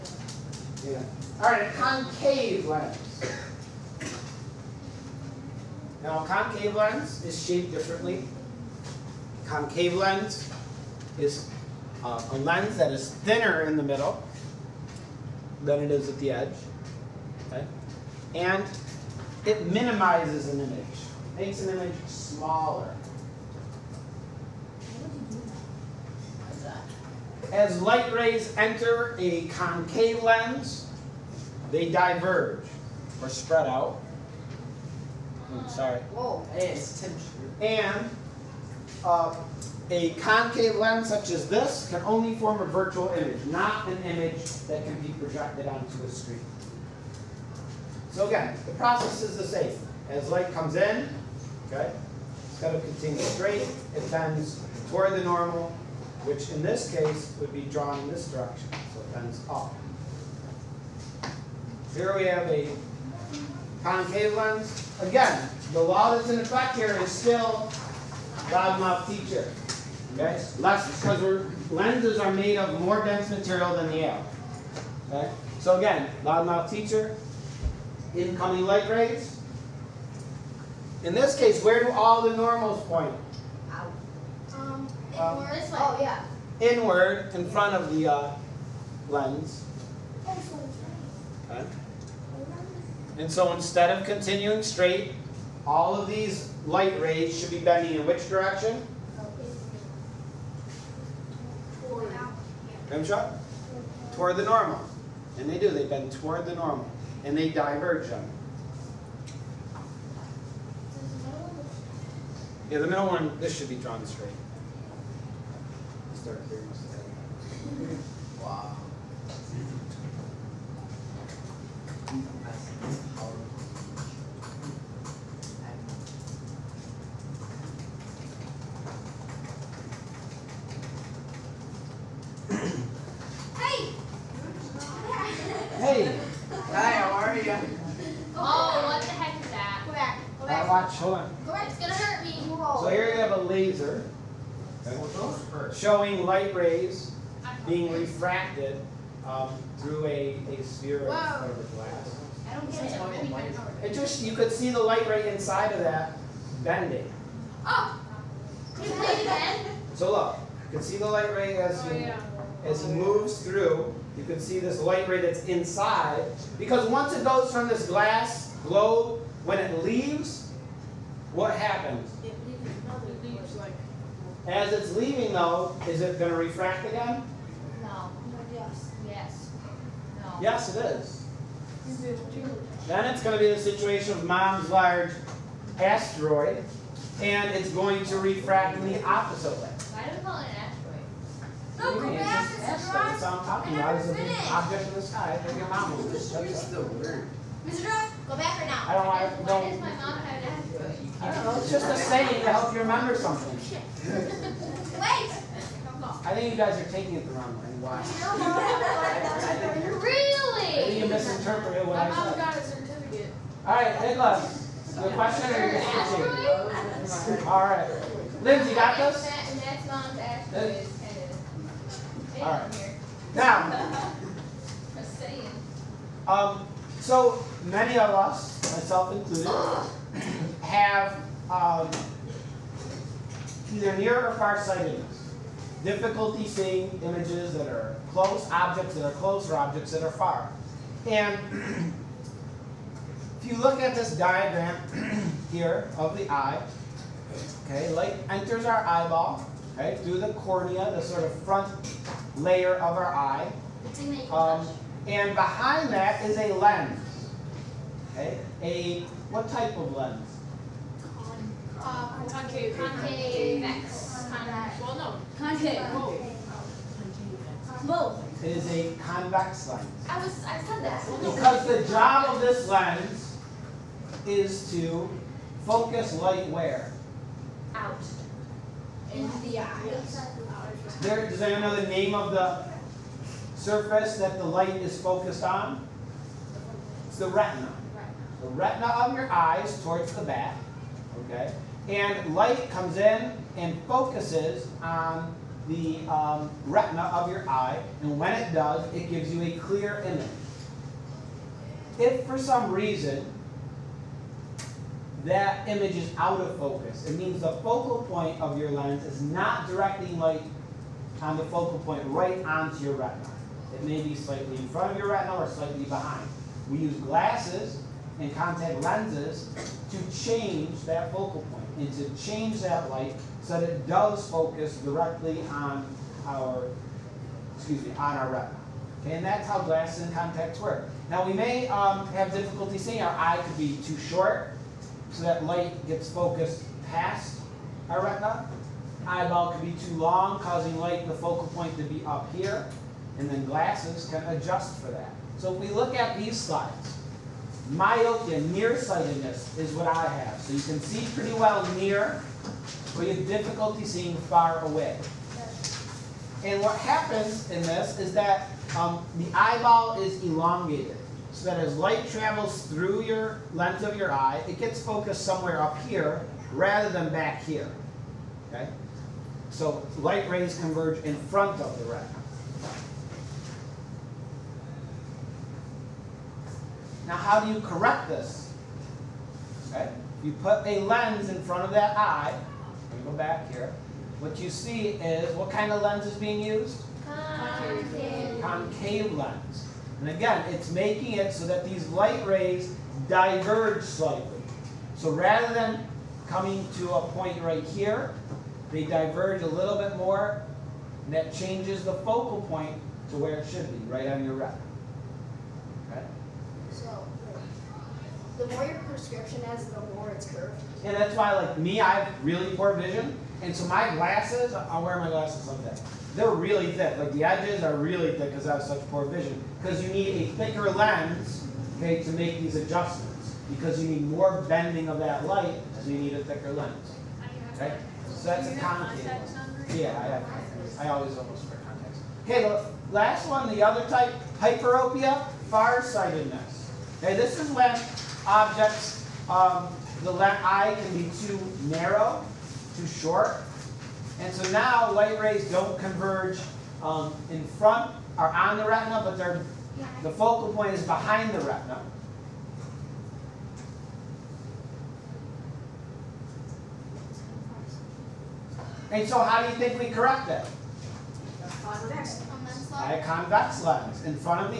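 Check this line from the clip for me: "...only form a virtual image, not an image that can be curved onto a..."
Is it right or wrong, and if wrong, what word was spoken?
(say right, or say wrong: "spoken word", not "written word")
wrong: "projected", not "curved".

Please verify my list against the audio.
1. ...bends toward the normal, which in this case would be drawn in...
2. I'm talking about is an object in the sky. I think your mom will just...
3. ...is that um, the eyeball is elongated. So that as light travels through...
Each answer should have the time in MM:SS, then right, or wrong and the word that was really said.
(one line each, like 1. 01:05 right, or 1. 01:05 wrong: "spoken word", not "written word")
1. 00:54 right
2. 03:13 right
3. 05:57 right.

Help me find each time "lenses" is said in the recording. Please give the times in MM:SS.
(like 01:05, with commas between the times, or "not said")
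01:11, 05:18.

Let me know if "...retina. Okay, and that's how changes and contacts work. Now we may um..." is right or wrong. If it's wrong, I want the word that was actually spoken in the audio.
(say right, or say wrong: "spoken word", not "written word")
wrong: "glasses", not "changes".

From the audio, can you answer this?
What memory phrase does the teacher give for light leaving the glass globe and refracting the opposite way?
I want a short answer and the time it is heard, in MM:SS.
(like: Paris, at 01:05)
mom's large asteroid, at 03:04.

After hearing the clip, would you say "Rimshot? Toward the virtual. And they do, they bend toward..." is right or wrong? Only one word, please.
wrong.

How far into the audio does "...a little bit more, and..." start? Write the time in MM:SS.
06:39.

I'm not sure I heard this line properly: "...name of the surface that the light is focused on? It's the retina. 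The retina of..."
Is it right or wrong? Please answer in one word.
right.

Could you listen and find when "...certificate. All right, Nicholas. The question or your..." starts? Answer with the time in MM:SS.
03:32.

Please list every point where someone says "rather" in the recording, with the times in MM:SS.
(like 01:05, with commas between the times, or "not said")
06:06, 06:35.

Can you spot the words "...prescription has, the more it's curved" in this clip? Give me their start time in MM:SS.
06:48.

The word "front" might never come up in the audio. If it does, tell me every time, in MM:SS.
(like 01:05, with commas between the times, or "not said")
01:27, 04:11, 05:14, 06:11, 06:21, 07:27.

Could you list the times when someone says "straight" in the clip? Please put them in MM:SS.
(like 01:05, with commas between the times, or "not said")
00:53, 01:34, 01:54.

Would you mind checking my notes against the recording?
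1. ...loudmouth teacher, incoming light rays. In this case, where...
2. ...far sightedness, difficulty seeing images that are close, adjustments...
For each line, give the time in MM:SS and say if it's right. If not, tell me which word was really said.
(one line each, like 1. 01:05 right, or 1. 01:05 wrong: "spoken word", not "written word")
1. 01:16 right
2. 03:54 wrong: "objects", not "adjustments".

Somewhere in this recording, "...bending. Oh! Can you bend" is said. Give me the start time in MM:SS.
02:36.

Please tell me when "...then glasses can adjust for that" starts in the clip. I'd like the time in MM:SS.
05:43.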